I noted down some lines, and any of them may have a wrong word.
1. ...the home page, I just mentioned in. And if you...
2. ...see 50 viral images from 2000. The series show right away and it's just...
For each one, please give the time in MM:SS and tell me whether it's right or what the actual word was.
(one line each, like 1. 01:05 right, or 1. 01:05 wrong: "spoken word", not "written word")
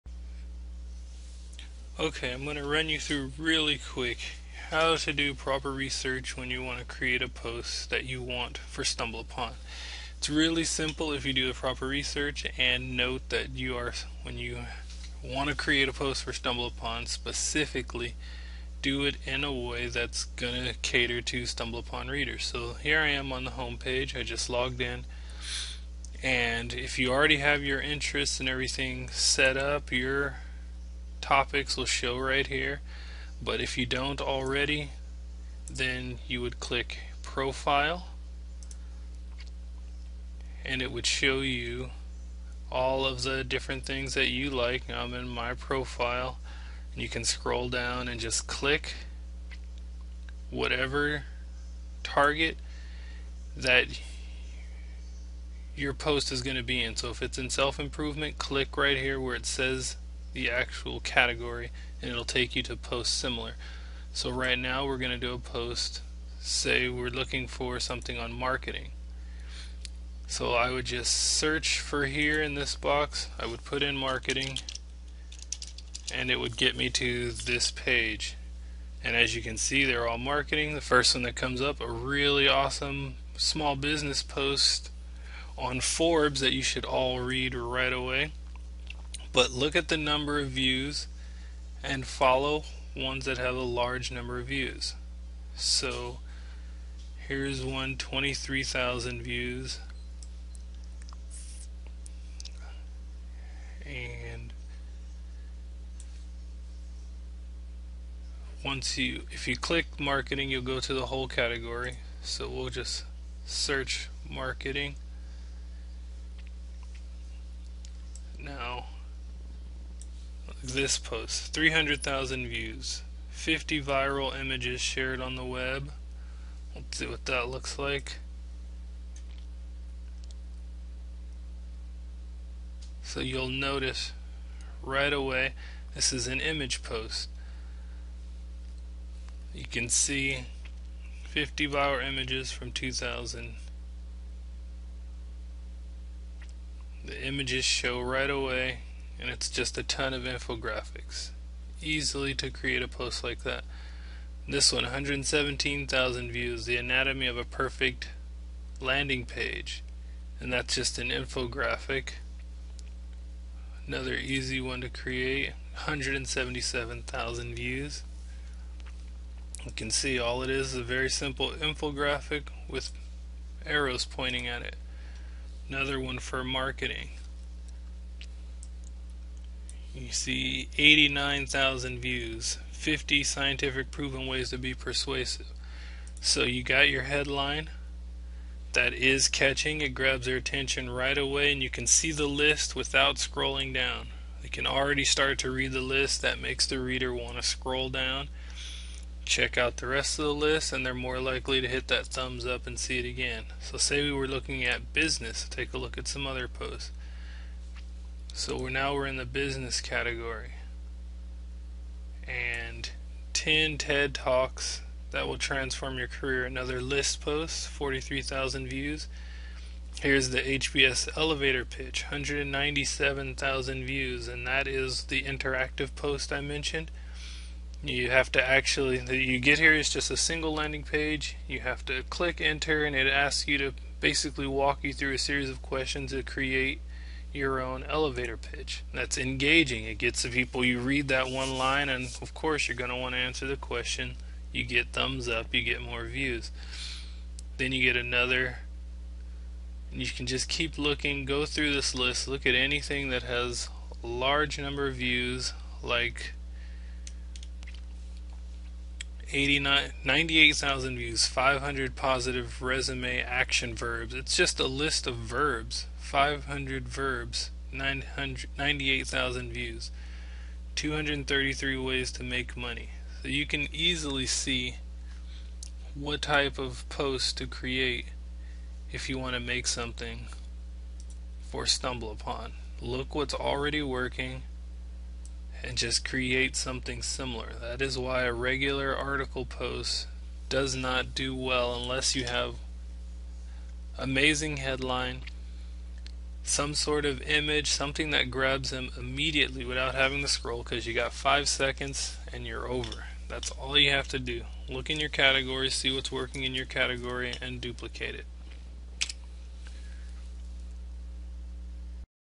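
1. 00:23 wrong: "logged", not "mentioned"
2. 02:19 wrong: "images", not "series".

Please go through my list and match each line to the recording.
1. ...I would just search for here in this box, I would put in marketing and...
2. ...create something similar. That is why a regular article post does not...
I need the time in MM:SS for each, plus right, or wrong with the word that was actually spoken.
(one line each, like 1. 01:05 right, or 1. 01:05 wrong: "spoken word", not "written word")
1. 01:10 right
2. 04:46 right.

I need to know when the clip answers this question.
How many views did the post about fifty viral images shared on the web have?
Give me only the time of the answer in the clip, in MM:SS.
02:01.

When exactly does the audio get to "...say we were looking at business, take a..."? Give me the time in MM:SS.
03:23.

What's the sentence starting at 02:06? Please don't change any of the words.
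Let's see what that looks like.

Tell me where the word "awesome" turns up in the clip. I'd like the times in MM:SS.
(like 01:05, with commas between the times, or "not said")
01:22.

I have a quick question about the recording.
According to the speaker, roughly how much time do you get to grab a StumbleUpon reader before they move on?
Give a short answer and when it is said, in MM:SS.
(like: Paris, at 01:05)
5 seconds, at 05:01.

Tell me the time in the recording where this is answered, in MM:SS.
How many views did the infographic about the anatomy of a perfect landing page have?
02:34.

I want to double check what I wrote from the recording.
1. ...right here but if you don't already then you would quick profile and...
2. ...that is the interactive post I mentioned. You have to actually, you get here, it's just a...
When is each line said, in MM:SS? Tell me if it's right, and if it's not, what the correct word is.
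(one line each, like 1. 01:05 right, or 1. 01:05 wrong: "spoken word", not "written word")
1. 00:32 wrong: "click", not "quick"
2. 03:44 right.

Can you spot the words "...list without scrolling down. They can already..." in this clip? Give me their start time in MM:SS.
03:12.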